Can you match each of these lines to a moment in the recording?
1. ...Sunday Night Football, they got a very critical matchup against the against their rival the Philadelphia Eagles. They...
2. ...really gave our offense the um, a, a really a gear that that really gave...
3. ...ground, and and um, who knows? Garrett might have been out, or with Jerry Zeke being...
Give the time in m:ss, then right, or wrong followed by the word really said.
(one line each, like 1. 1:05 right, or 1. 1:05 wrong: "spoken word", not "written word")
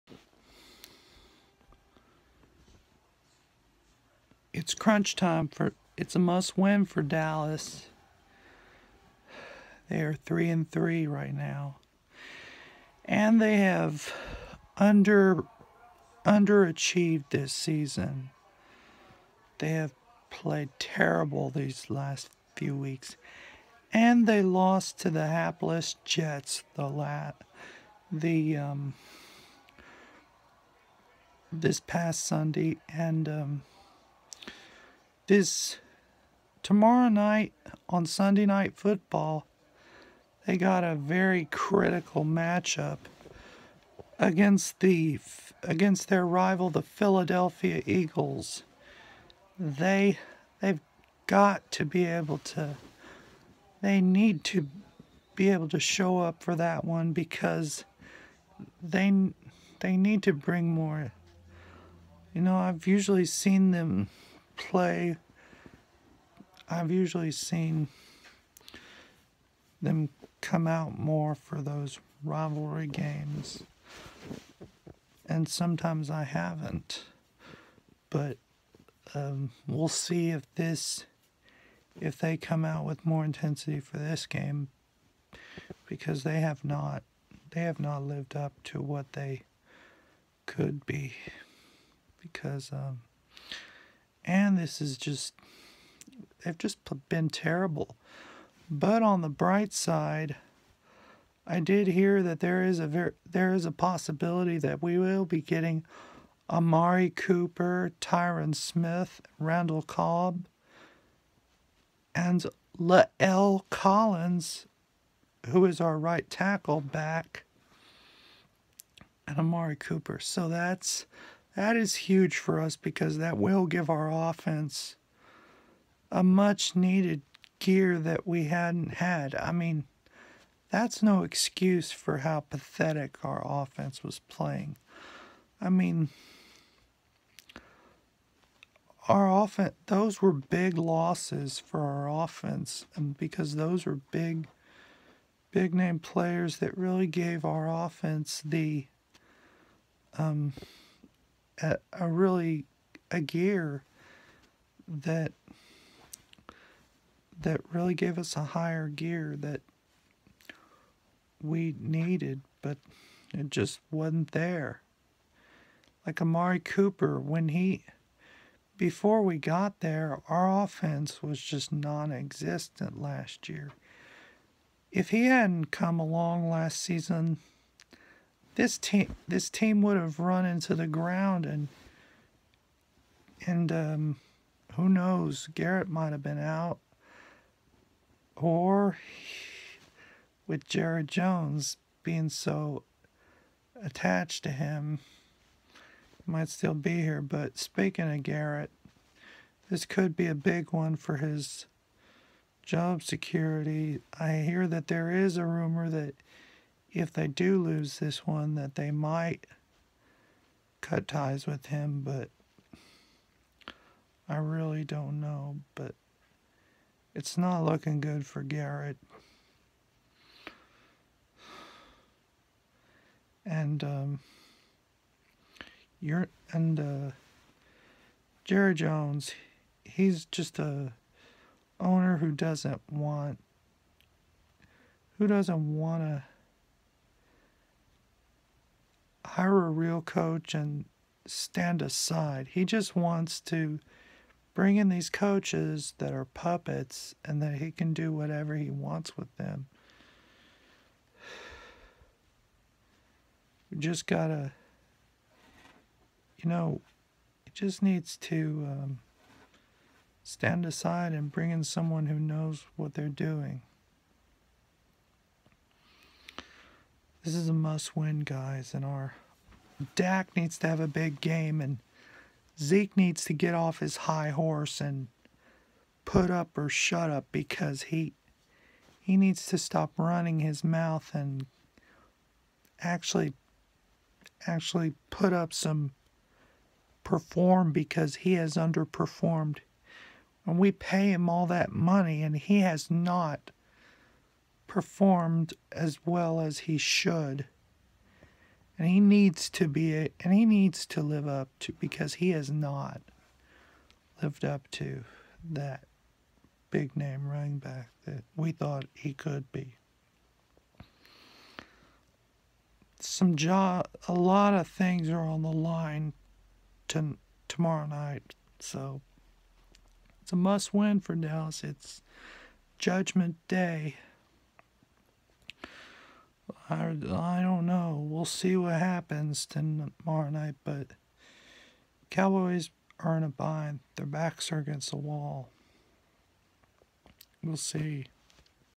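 1. 0:38 right
2. 2:26 right
3. 3:00 wrong: "Jones", not "Zeke".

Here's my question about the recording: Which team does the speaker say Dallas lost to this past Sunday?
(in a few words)
Jets.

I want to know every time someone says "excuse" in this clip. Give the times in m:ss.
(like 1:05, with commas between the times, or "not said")
2:11.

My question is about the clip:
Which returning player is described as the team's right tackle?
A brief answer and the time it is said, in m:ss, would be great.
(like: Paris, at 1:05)
La'el Collins, at 1:52.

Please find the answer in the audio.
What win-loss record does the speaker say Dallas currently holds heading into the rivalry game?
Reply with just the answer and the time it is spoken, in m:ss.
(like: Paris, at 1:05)
3 and 3, at 0:10.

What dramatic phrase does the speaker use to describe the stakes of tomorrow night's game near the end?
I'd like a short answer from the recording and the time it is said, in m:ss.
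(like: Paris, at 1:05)
Judgment Day, at 5:22.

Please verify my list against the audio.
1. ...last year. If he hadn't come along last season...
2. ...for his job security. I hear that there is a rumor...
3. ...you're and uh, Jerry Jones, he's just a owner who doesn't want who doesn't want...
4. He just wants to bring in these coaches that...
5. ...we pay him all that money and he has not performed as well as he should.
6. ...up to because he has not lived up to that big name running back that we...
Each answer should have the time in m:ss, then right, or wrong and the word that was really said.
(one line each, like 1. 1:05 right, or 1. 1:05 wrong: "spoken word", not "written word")
1. 2:53 right
2. 3:20 right
3. 3:46 right
4. 4:02 right
5. 4:50 right
6. 5:01 right.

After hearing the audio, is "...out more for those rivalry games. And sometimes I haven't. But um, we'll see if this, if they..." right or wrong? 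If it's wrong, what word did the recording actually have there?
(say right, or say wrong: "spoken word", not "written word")
right.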